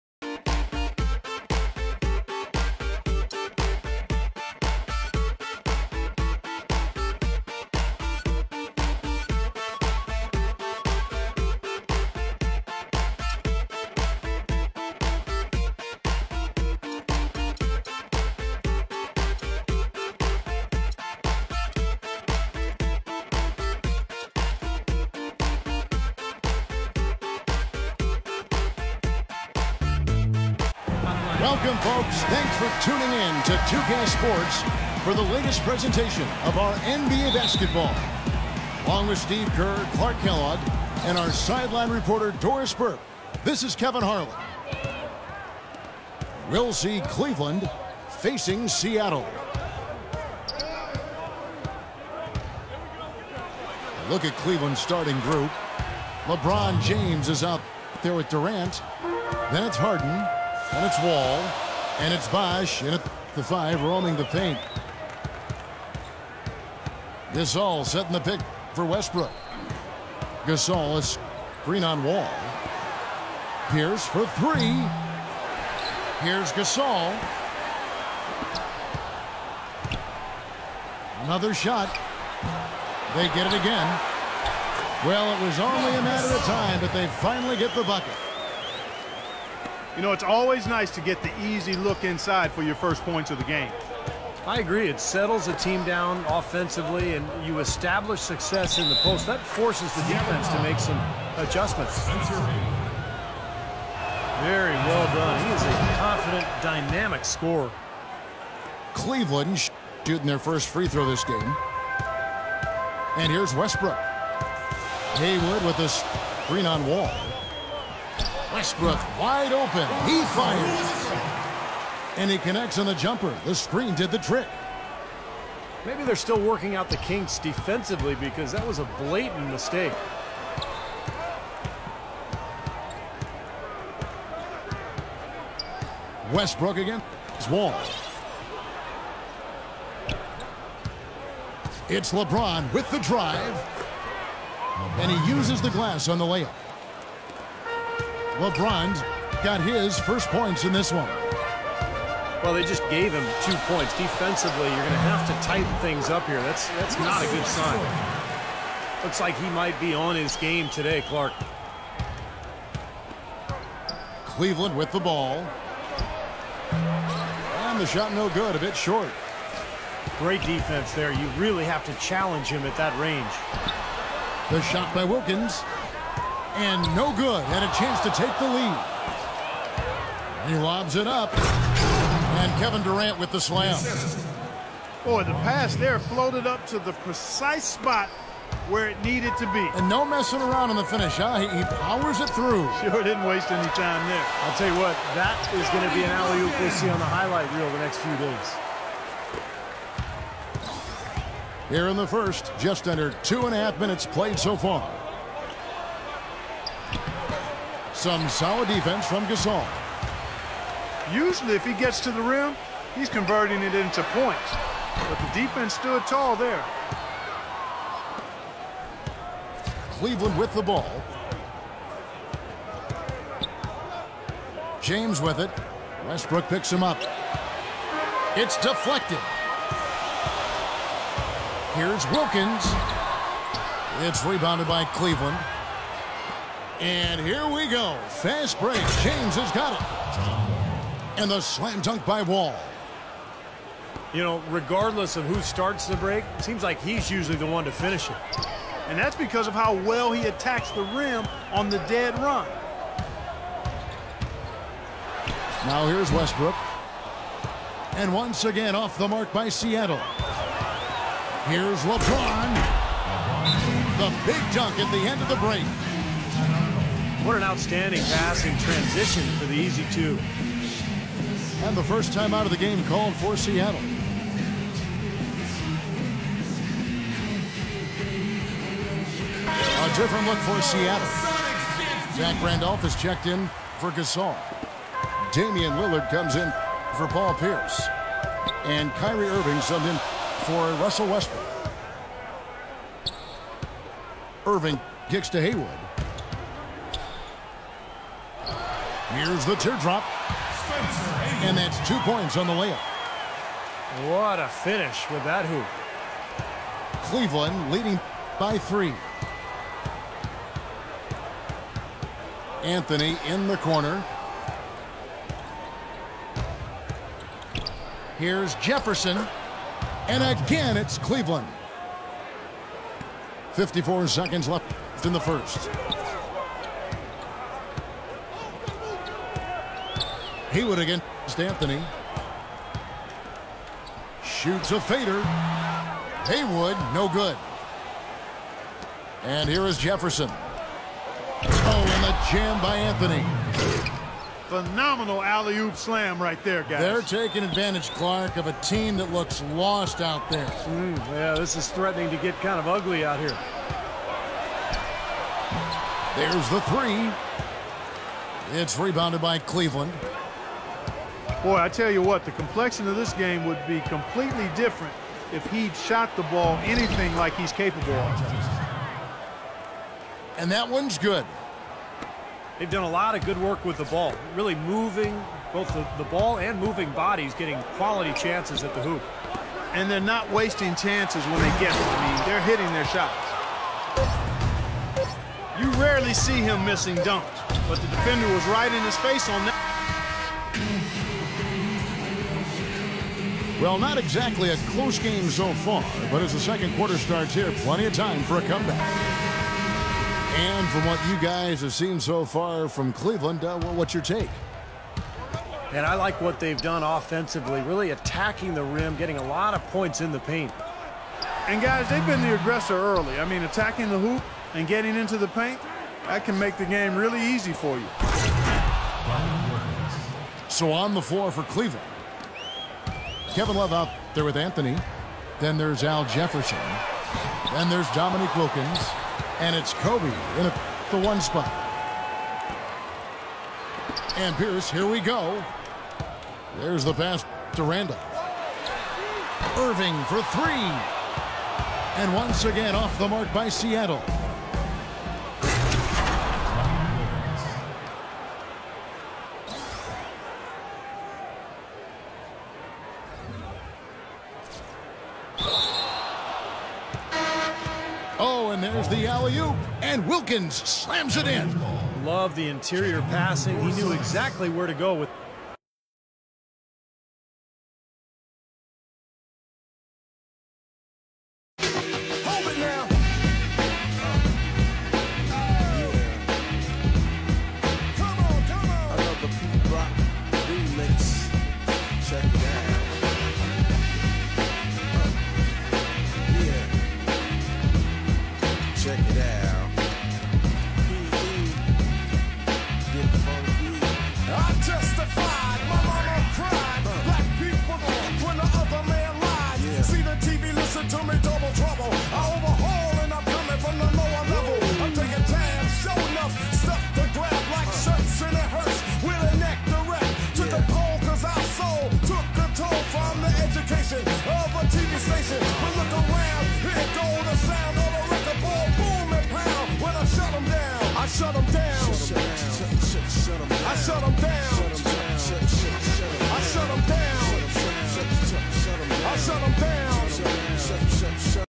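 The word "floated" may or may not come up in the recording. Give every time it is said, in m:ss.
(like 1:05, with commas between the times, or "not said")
3:05.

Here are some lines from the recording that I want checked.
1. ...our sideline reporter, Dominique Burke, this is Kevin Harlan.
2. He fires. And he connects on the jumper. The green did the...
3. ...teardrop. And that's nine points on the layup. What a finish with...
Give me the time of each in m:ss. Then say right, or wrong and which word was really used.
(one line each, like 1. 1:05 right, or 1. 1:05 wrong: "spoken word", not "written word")
1. 0:41 wrong: "Doris", not "Dominique"
2. 2:00 wrong: "screen", not "green"
3. 4:59 wrong: "two", not "nine".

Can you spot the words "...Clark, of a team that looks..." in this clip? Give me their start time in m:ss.
5:47.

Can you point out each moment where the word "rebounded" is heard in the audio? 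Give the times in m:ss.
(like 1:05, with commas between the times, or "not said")
3:54, 5:58.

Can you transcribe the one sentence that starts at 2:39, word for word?
Looks like he might be on his game today, Clark.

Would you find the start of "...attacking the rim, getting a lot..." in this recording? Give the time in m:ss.
6:47.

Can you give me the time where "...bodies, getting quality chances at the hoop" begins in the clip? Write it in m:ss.
6:16.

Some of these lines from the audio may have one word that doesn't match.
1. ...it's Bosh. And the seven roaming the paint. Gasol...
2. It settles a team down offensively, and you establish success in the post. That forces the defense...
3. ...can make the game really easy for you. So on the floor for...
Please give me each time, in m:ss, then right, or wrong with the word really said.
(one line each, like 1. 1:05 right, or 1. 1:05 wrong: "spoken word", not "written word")
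1. 1:02 wrong: "five", not "seven"
2. 1:34 right
3. 6:56 right.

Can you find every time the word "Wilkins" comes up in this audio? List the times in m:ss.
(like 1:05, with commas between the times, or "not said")
2:55, 3:52, 7:08, 7:40.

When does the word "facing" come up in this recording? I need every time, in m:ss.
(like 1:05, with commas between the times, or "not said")
0:48.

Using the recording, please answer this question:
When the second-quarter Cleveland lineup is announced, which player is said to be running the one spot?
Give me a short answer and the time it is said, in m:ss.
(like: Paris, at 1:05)
Kobe, at 7:09.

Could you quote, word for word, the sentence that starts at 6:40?
And from what you guys have seen so far from Cleveland, uh, what's your take?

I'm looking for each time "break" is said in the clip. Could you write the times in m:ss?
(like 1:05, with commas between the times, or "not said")
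3:58, 4:05, 4:25.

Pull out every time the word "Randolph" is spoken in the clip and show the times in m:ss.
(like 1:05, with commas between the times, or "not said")
4:42, 7:17.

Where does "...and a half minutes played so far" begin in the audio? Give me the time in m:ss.
3:23.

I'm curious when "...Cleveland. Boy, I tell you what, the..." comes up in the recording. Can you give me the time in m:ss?
5:59.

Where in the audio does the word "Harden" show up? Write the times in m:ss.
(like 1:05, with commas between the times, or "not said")
0:59.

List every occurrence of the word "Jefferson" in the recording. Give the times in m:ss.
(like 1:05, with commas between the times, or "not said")
5:18, 5:39, 7:06.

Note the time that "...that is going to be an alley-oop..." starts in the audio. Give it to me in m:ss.
3:15.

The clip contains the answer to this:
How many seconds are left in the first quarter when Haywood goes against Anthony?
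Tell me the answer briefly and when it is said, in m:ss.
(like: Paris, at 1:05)
54, at 5:23.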